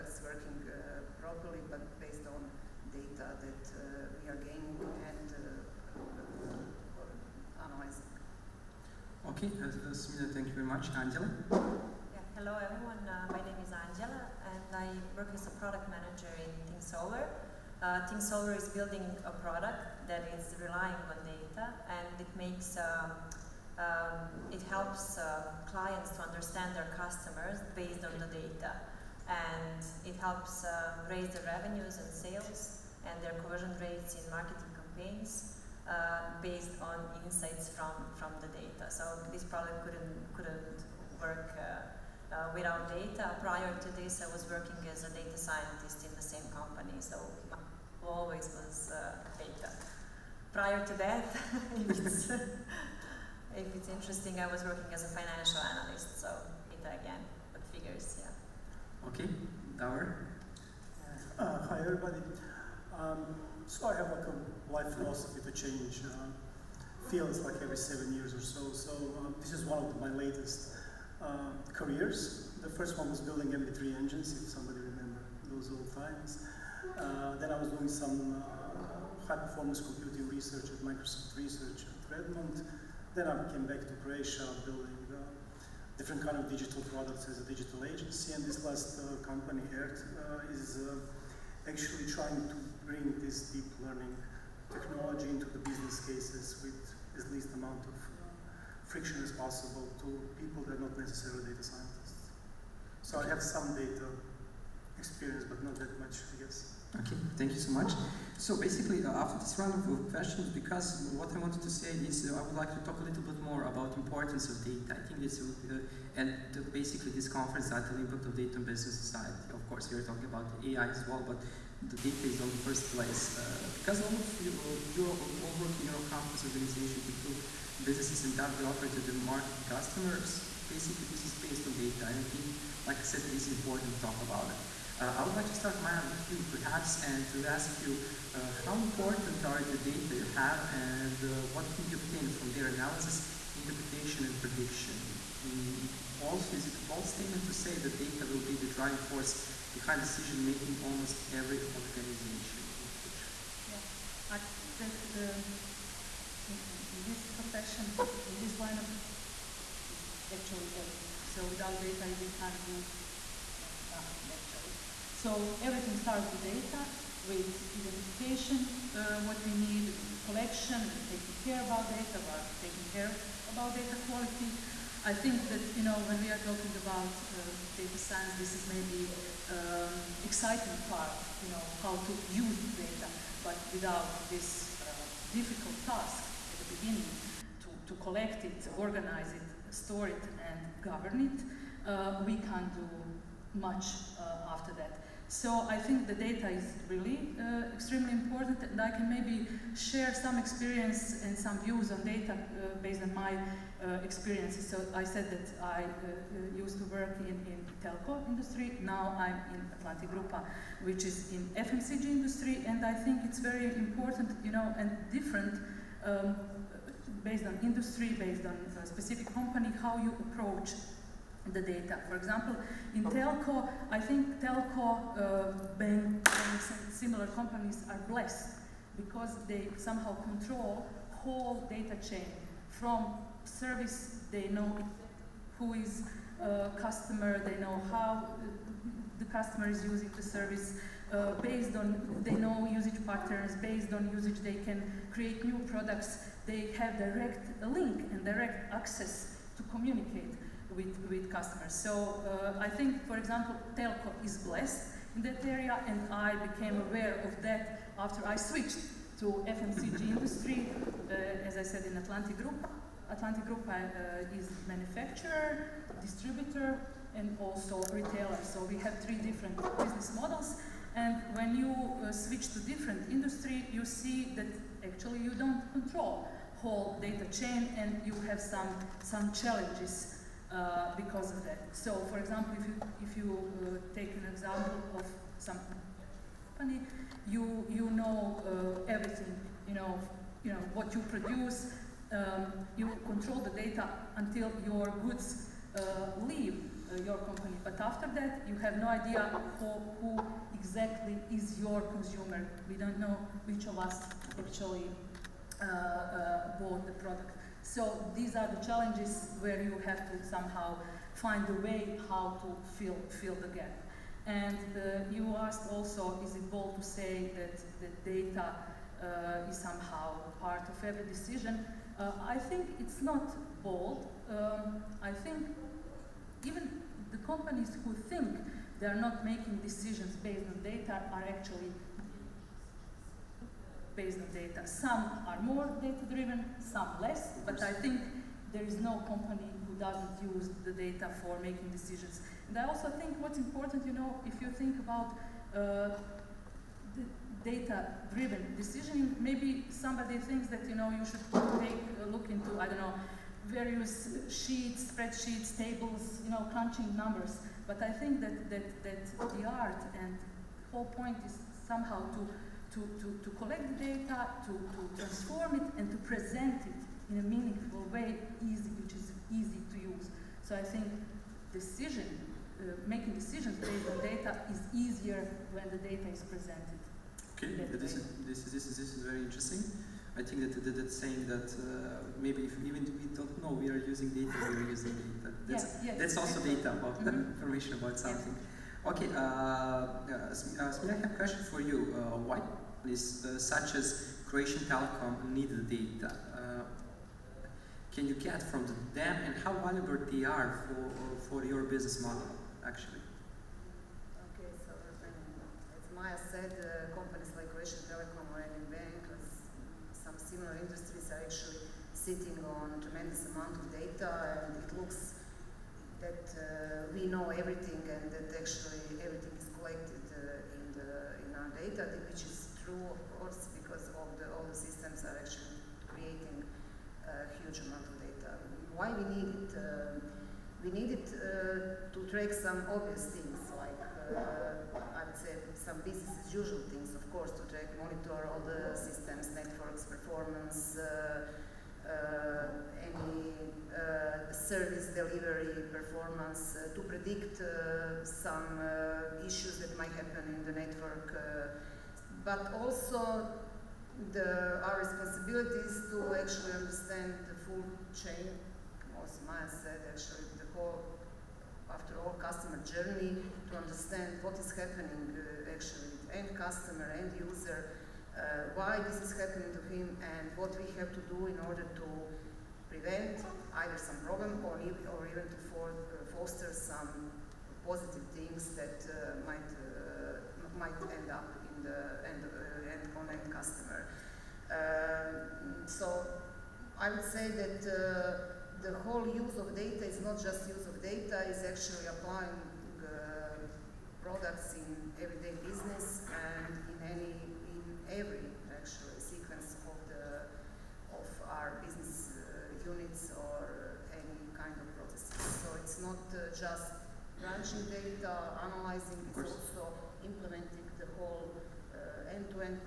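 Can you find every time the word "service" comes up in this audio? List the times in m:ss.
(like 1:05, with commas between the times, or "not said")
3:53, 4:00, 7:24.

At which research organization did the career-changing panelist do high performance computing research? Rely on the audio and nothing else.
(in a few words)
Microsoft Research.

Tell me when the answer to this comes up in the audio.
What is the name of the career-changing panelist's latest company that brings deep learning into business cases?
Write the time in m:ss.
1:29.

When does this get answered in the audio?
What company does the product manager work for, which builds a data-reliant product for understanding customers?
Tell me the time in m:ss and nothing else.
0:16.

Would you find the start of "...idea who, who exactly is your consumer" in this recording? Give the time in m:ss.
4:58.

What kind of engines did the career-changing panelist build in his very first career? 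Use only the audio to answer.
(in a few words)
MP3 engines.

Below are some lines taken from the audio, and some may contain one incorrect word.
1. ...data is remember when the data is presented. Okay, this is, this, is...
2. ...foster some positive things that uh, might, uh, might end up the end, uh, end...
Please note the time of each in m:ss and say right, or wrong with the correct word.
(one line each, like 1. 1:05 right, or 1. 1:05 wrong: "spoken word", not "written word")
1. 6:14 wrong: "easier", not "remember"
2. 7:56 right.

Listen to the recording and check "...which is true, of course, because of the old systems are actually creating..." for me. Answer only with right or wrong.
right.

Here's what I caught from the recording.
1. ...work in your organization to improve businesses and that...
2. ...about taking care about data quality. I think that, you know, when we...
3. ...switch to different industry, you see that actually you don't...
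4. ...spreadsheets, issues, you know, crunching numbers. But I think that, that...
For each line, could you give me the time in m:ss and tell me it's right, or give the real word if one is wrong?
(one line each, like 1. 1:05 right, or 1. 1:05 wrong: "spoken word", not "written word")
1. 2:05 right
2. 2:52 right
3. 4:32 right
4. 5:54 wrong: "tables", not "issues".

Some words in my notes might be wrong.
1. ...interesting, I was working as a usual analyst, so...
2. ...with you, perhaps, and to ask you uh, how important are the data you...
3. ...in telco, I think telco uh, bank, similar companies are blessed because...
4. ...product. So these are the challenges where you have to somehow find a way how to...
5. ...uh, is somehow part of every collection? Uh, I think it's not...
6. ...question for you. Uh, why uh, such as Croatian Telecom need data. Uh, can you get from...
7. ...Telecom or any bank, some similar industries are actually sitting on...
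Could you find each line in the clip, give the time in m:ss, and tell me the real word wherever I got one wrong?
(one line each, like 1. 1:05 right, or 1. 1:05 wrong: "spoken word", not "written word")
1. 0:53 wrong: "financial", not "usual"
2. 2:16 right
3. 3:42 right
4. 5:06 right
5. 5:19 wrong: "decision", not "collection"
6. 6:31 right
7. 6:47 right.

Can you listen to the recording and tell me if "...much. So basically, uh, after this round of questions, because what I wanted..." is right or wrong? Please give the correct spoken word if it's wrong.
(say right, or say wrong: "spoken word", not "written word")
right.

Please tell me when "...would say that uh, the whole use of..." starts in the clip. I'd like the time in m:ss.
8:06.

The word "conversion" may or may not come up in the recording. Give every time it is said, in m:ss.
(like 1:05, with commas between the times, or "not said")
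0:33.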